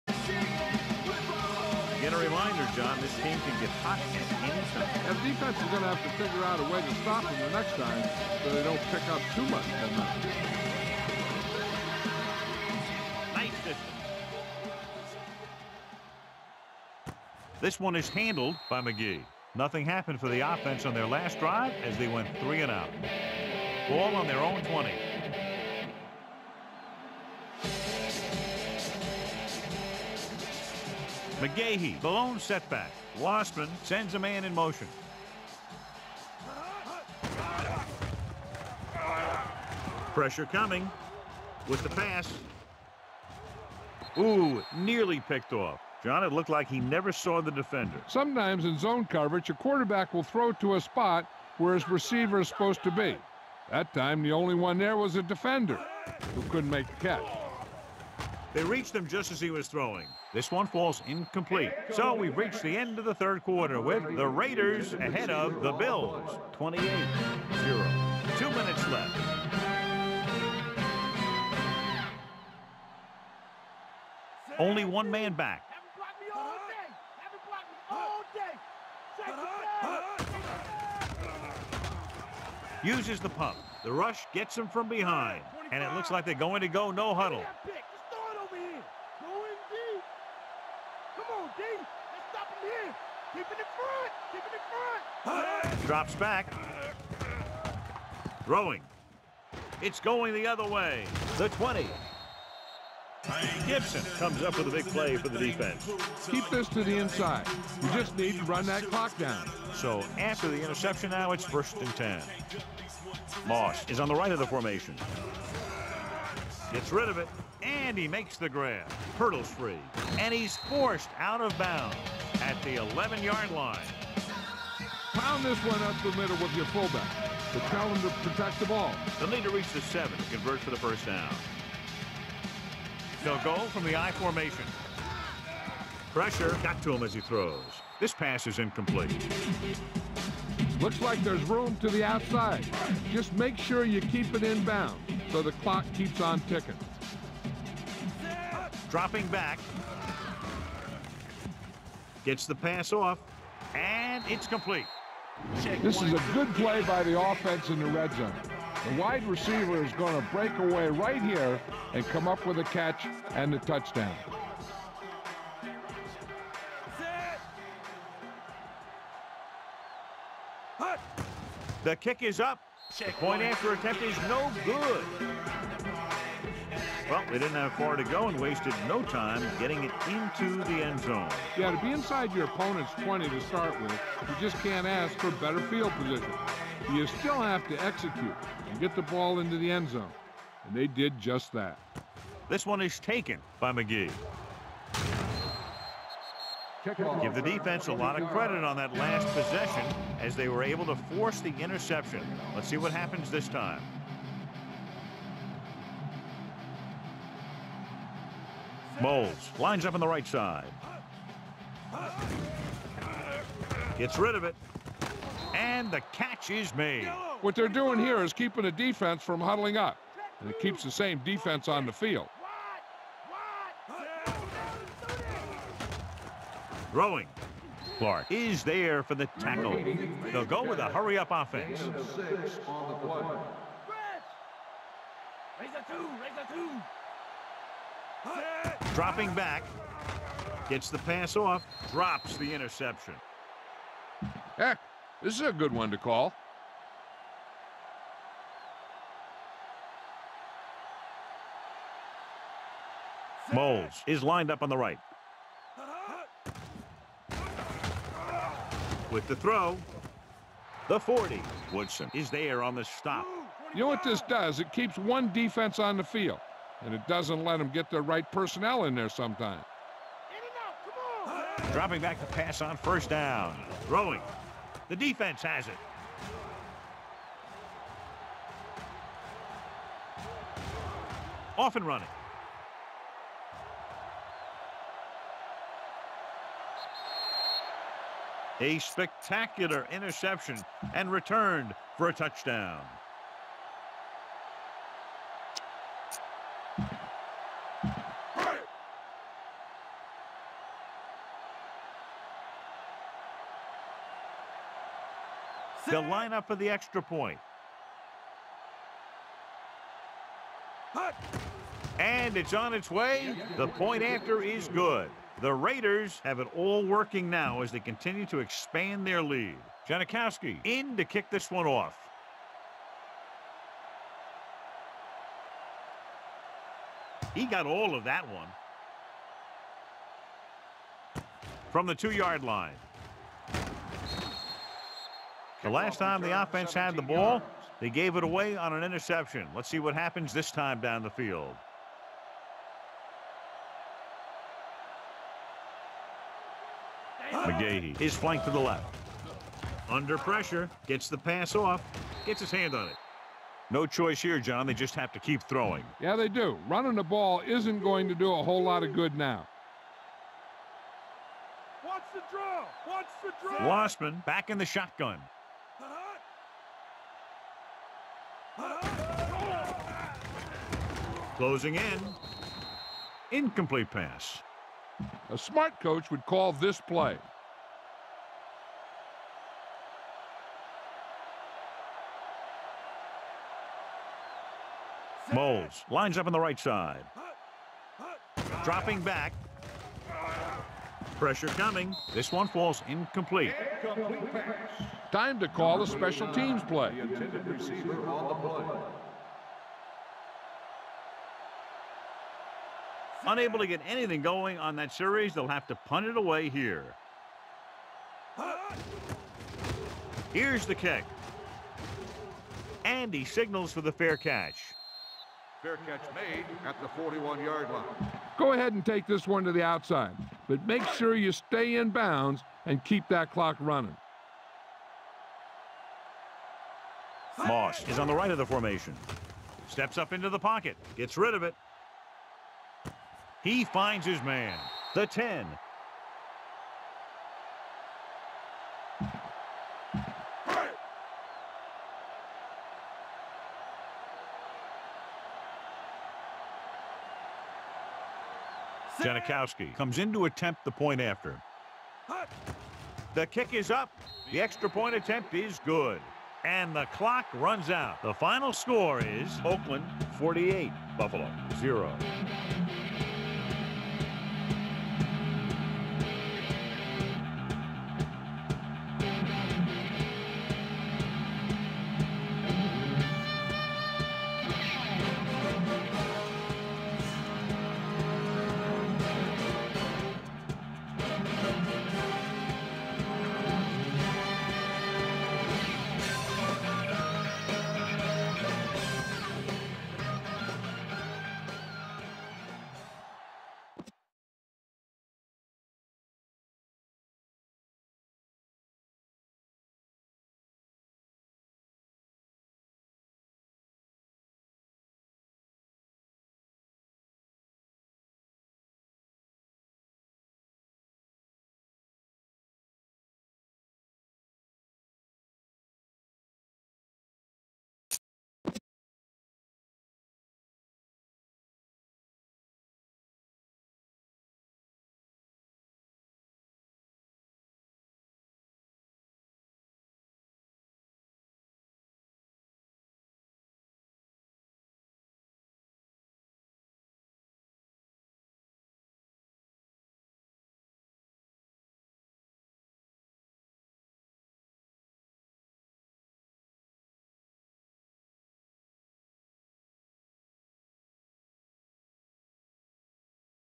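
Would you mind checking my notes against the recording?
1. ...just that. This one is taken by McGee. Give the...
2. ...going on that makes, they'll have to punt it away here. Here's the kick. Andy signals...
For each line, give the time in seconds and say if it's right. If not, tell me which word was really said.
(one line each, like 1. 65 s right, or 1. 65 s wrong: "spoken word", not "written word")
1. 191 s right
2. 404 s wrong: "series", not "makes".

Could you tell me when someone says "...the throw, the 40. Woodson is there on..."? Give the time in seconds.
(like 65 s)
259 s.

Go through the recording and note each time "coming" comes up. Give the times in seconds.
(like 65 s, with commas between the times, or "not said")
40 s, 391 s.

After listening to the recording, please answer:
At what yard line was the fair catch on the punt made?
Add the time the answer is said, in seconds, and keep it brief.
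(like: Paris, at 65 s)
41, at 416 s.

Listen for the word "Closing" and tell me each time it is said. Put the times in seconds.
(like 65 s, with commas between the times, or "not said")
371 s.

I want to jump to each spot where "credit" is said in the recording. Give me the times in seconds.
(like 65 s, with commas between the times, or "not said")
198 s.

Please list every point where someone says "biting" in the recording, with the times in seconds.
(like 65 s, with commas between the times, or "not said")
not said.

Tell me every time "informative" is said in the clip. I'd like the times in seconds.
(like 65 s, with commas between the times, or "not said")
not said.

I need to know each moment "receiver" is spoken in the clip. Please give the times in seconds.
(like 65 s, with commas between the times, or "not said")
51 s, 159 s.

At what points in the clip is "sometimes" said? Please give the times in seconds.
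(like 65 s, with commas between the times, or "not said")
48 s, 269 s.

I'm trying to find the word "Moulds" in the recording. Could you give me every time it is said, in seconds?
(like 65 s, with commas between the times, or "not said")
209 s, 253 s, 385 s.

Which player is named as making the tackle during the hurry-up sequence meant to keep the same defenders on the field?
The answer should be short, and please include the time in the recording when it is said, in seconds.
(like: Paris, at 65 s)
Clark, at 227 s.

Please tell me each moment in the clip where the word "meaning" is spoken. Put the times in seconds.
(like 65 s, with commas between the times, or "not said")
not said.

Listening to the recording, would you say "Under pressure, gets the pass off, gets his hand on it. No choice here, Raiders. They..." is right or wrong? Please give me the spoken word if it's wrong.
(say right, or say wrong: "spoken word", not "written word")
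wrong: "John", not "Raiders".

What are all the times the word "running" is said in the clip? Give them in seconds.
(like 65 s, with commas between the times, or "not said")
281 s, 356 s, 423 s.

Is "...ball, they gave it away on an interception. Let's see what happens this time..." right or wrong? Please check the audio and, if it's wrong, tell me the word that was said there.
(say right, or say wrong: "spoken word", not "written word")
right.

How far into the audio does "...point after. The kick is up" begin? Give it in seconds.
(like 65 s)
450 s.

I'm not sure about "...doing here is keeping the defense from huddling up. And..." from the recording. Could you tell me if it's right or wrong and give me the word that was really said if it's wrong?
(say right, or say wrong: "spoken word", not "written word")
right.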